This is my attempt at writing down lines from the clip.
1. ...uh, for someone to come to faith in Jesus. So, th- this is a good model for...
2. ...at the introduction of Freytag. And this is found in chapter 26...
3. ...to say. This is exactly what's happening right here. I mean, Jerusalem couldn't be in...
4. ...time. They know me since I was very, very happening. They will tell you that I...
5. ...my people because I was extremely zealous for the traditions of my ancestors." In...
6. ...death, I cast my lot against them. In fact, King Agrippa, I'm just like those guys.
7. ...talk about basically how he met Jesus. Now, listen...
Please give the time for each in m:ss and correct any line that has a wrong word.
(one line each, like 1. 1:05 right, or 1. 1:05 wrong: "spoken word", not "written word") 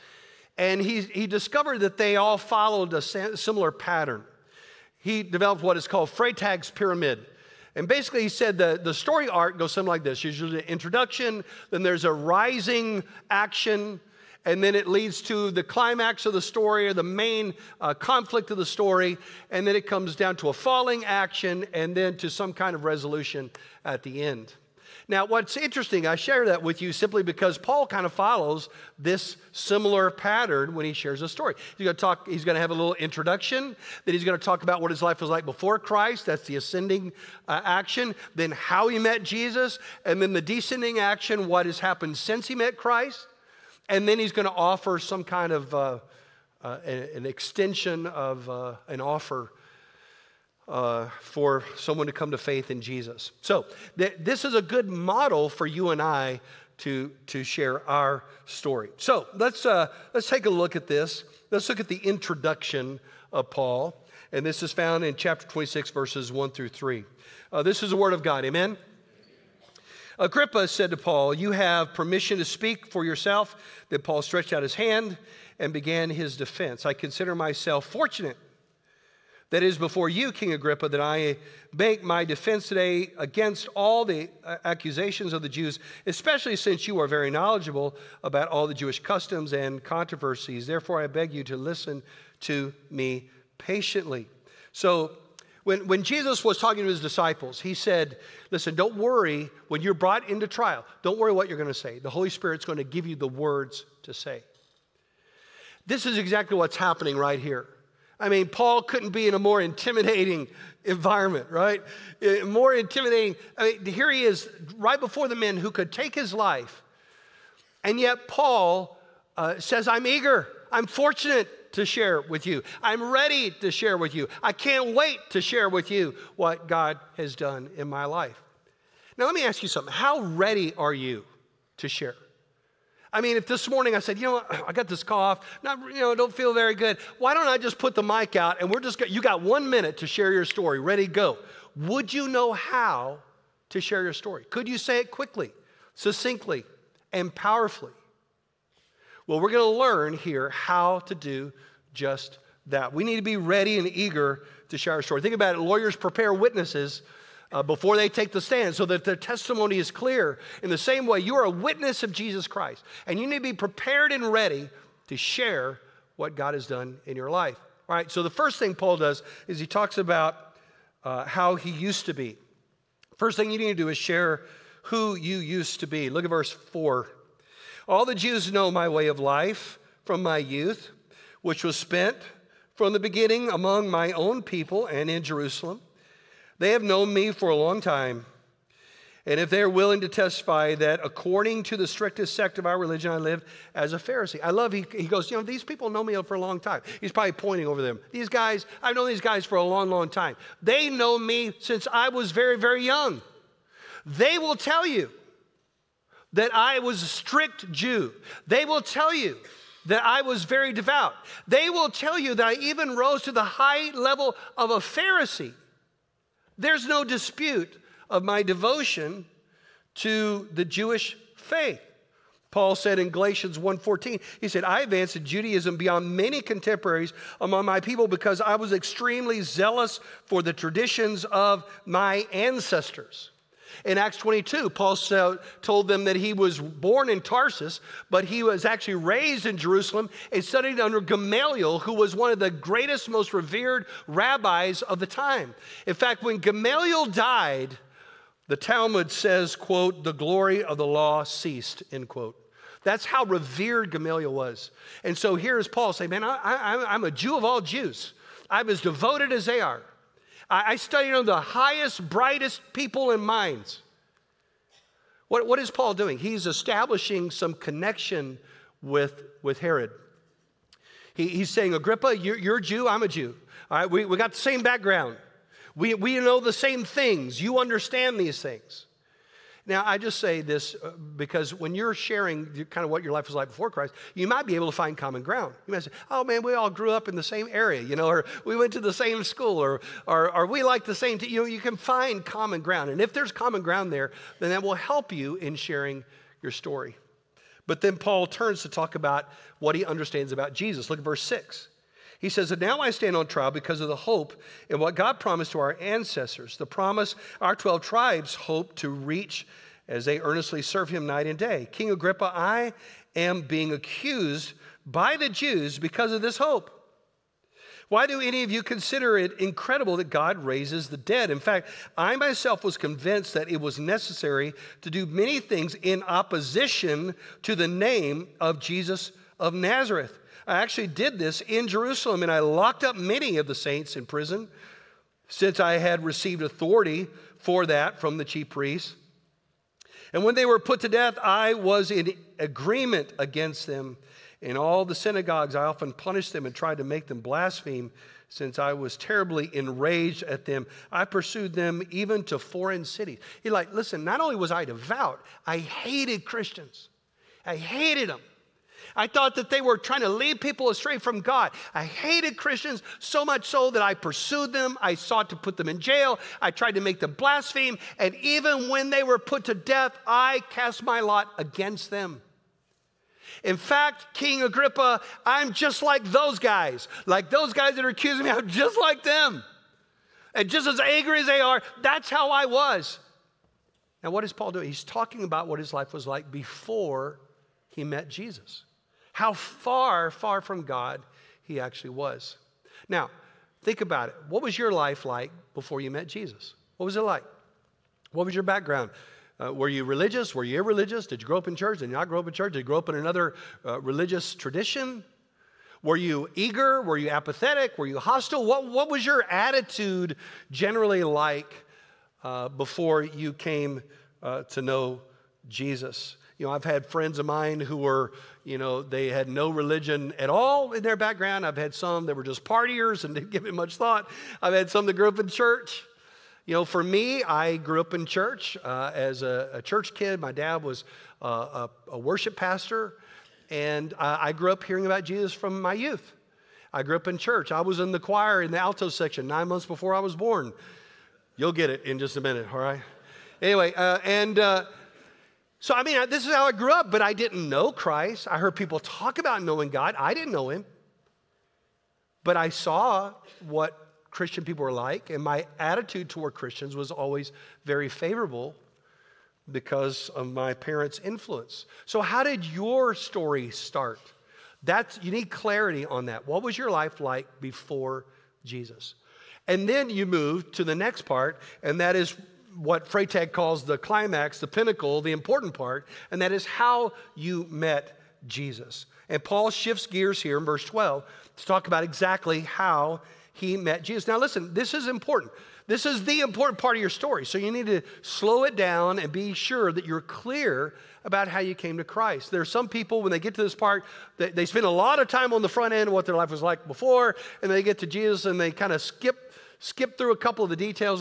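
1. 0:50 right
2. 1:01 wrong: "Paul", not "Freytag"
3. 1:44 wrong: "Paul", not "Jerusalem"
4. 3:20 wrong: "young", not "happening"
5. 3:47 right
6. 6:09 right
7. 8:01 wrong: "exactly", not "basically".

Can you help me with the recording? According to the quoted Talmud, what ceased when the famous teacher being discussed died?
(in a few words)
the glory of the law.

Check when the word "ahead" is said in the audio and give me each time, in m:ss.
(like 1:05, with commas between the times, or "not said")
not said.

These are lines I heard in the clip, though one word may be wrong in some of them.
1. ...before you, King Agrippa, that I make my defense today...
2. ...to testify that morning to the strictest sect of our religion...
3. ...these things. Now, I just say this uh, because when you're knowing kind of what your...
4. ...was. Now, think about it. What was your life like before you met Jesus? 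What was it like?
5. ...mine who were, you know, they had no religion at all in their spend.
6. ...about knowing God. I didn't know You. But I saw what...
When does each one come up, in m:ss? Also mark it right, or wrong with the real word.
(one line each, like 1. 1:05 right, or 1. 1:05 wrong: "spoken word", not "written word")
1. 1:19 right
2. 3:10 wrong: "according", not "morning"
3. 4:38 wrong: "sharing", not "knowing"
4. 6:31 right
5. 6:57 wrong: "background", not "spend"
6. 7:29 wrong: "Him", not "You".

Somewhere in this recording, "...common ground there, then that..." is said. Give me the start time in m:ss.
4:53.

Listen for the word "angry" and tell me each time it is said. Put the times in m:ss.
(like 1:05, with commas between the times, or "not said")
6:20.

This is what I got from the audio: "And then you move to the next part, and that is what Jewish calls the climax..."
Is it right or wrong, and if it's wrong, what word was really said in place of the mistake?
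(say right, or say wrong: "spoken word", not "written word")
wrong: "Freytag", not "Jewish".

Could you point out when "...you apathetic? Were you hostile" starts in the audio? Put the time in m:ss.
6:46.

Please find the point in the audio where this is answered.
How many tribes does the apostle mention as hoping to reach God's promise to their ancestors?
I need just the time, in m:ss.
5:07.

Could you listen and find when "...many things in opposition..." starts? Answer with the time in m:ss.
5:25.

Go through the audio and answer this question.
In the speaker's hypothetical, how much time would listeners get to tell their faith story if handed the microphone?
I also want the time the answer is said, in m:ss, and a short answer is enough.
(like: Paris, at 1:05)
1 minute, at 2:19.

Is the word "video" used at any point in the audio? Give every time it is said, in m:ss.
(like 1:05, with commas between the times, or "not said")
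not said.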